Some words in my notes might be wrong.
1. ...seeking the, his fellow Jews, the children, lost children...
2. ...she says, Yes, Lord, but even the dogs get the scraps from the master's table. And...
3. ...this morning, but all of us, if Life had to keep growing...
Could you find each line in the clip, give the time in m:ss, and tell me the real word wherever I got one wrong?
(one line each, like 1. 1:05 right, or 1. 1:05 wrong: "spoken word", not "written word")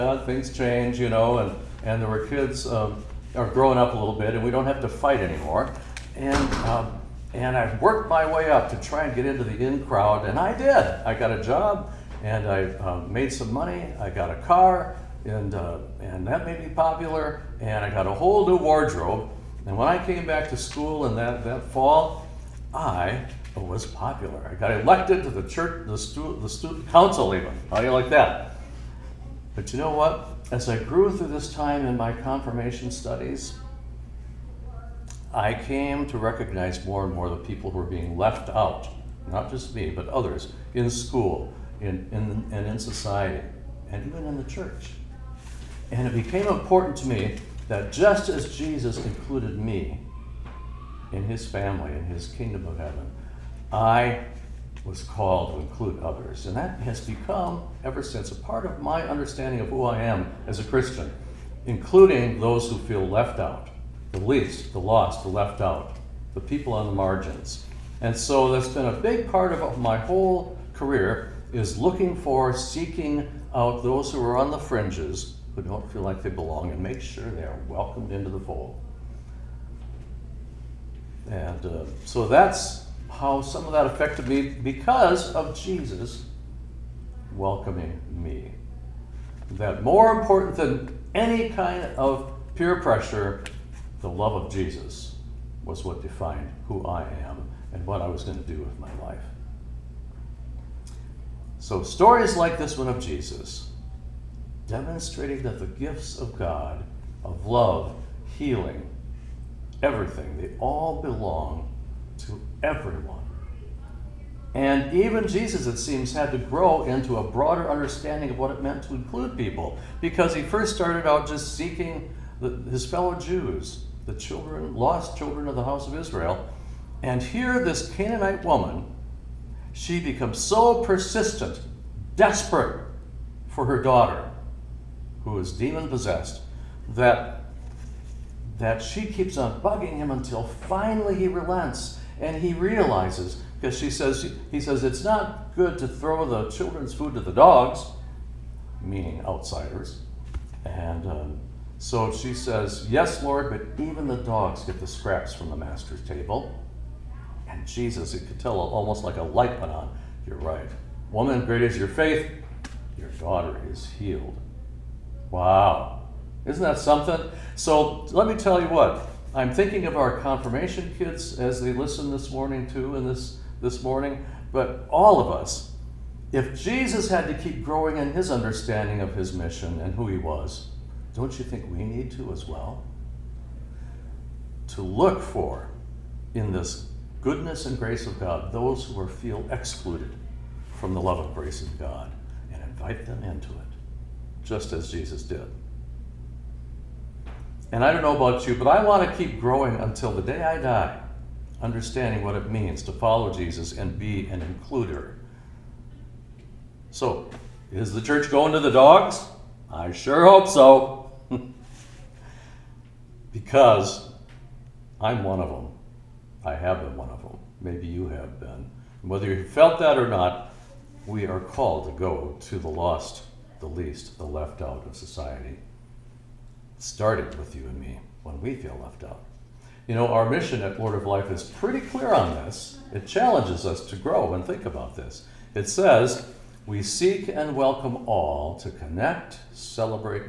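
1. 2:01 right
2. 2:32 right
3. 2:53 wrong: "Jesus", not "Life".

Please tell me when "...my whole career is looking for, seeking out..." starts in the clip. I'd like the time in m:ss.
1:09.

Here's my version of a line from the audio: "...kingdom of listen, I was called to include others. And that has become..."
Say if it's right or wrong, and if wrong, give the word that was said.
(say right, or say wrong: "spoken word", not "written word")
wrong: "heaven", not "listen".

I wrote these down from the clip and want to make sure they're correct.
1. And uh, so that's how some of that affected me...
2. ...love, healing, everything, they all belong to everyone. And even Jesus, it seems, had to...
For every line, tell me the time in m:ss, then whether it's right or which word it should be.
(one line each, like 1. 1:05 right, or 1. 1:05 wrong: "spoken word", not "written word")
1. 1:21 right
2. 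1:47 right.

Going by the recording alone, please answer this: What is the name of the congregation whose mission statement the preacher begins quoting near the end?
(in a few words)
Lord of Life.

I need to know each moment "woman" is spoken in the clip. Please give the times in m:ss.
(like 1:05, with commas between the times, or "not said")
2:08, 2:41.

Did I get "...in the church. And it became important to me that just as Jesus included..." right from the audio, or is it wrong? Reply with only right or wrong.
right.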